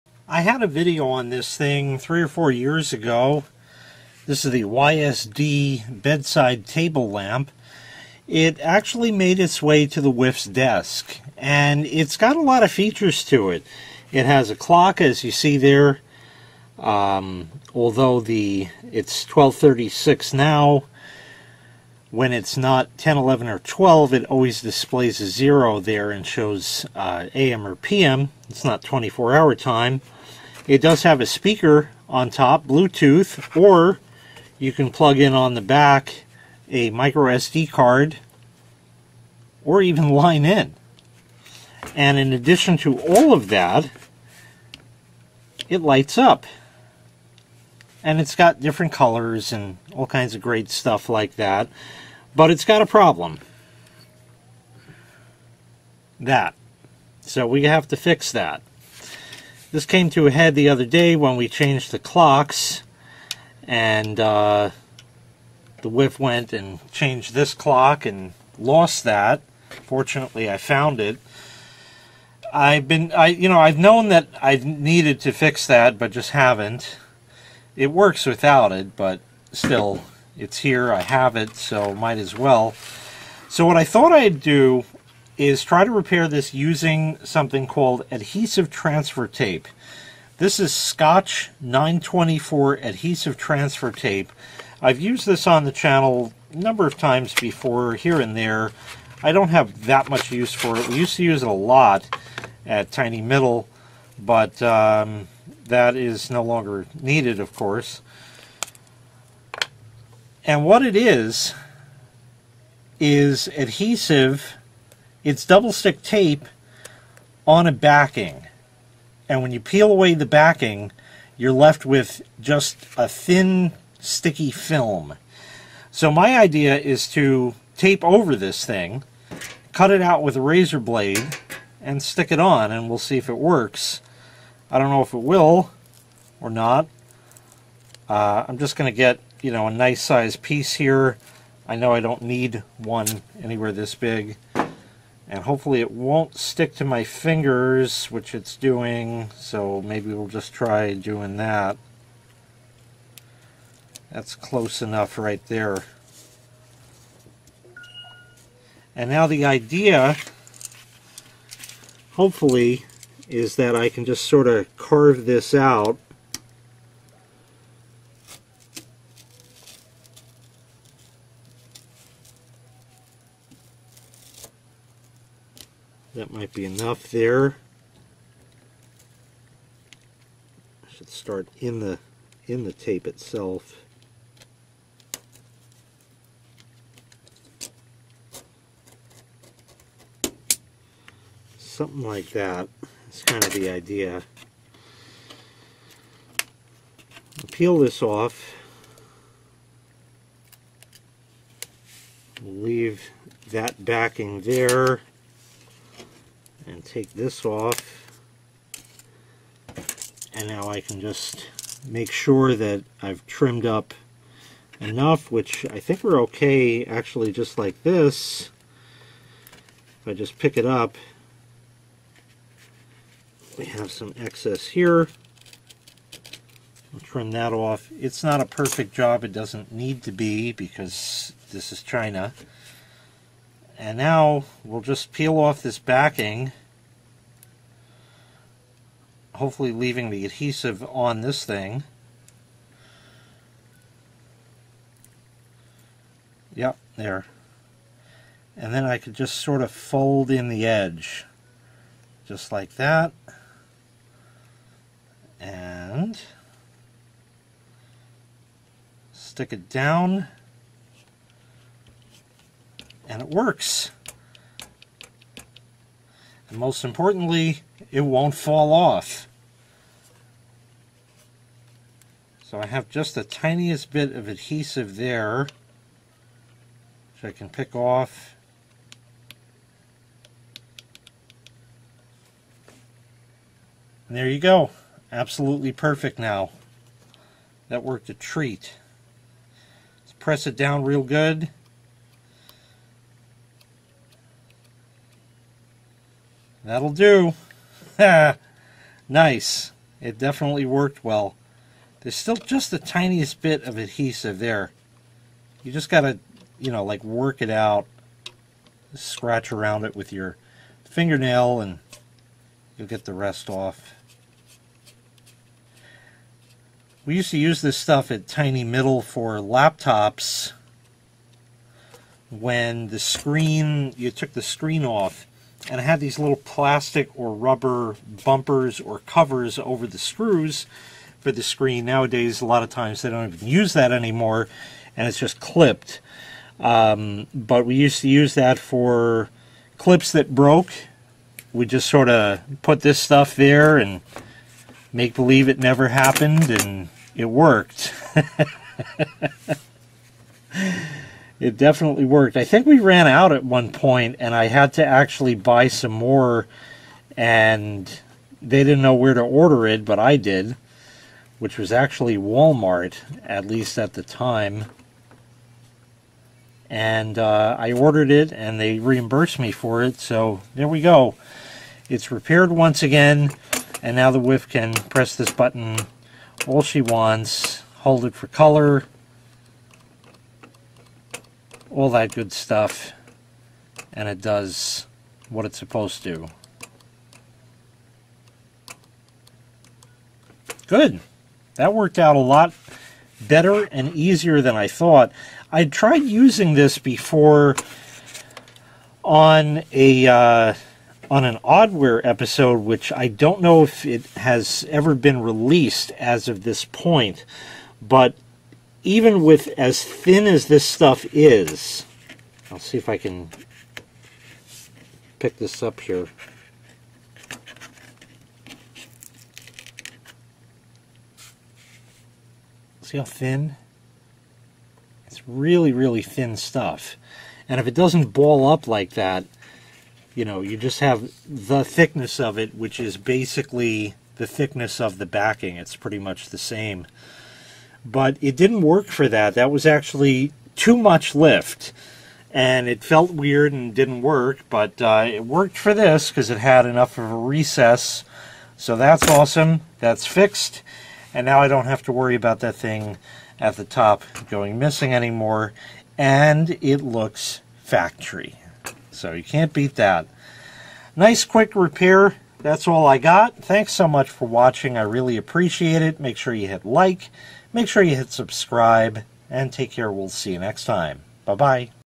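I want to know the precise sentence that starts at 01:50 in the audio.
And what it is, is adhesive, it's double stick tape on a backing.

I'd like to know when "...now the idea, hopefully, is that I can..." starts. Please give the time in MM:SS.
02:39.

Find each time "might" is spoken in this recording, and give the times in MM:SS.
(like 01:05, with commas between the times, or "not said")
01:21, 02:56.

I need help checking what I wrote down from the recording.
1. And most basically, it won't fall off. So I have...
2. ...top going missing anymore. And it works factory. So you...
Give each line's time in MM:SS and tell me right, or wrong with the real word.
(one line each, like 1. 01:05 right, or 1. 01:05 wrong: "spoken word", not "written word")
1. 04:26 wrong: "importantly", not "basically"
2. 07:33 wrong: "looks", not "works".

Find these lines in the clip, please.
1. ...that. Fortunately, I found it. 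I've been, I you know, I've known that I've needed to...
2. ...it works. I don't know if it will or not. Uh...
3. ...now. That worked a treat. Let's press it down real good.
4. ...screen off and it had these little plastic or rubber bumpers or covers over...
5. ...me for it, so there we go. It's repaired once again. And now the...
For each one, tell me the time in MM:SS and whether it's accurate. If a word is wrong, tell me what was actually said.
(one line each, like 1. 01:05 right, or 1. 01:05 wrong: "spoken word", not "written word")
1. 01:09 right
2. 02:13 right
3. 04:46 right
4. 05:24 right
5. 06:09 right.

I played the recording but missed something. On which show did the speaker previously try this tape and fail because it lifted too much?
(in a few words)
Oddware.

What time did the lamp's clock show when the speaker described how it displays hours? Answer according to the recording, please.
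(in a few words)
12:36.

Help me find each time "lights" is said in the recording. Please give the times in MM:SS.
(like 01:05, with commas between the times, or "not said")
00:45.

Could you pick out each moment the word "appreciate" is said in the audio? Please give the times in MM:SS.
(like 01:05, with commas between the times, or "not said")
07:45.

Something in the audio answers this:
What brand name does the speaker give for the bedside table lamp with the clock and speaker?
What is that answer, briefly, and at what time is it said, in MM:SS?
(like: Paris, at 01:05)
YSD, at 00:04.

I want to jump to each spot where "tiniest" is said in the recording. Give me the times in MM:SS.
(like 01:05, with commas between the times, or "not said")
04:33, 05:02.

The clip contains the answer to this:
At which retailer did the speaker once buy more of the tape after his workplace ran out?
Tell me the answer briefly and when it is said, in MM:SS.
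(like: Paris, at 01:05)
Walmart, at 06:02.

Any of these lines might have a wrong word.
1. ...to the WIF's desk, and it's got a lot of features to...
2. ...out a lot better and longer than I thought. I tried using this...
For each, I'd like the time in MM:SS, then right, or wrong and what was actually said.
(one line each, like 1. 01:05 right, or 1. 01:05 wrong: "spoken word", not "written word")
1. 00:09 right
2. 06:31 wrong: "easier", not "longer".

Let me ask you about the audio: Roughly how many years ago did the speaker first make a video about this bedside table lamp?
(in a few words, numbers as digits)
3 or 4 years.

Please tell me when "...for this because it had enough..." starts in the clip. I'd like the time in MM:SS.
07:25.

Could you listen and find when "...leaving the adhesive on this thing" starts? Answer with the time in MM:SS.
03:59.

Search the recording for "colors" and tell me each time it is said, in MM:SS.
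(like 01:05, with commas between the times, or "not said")
00:48, 06:18.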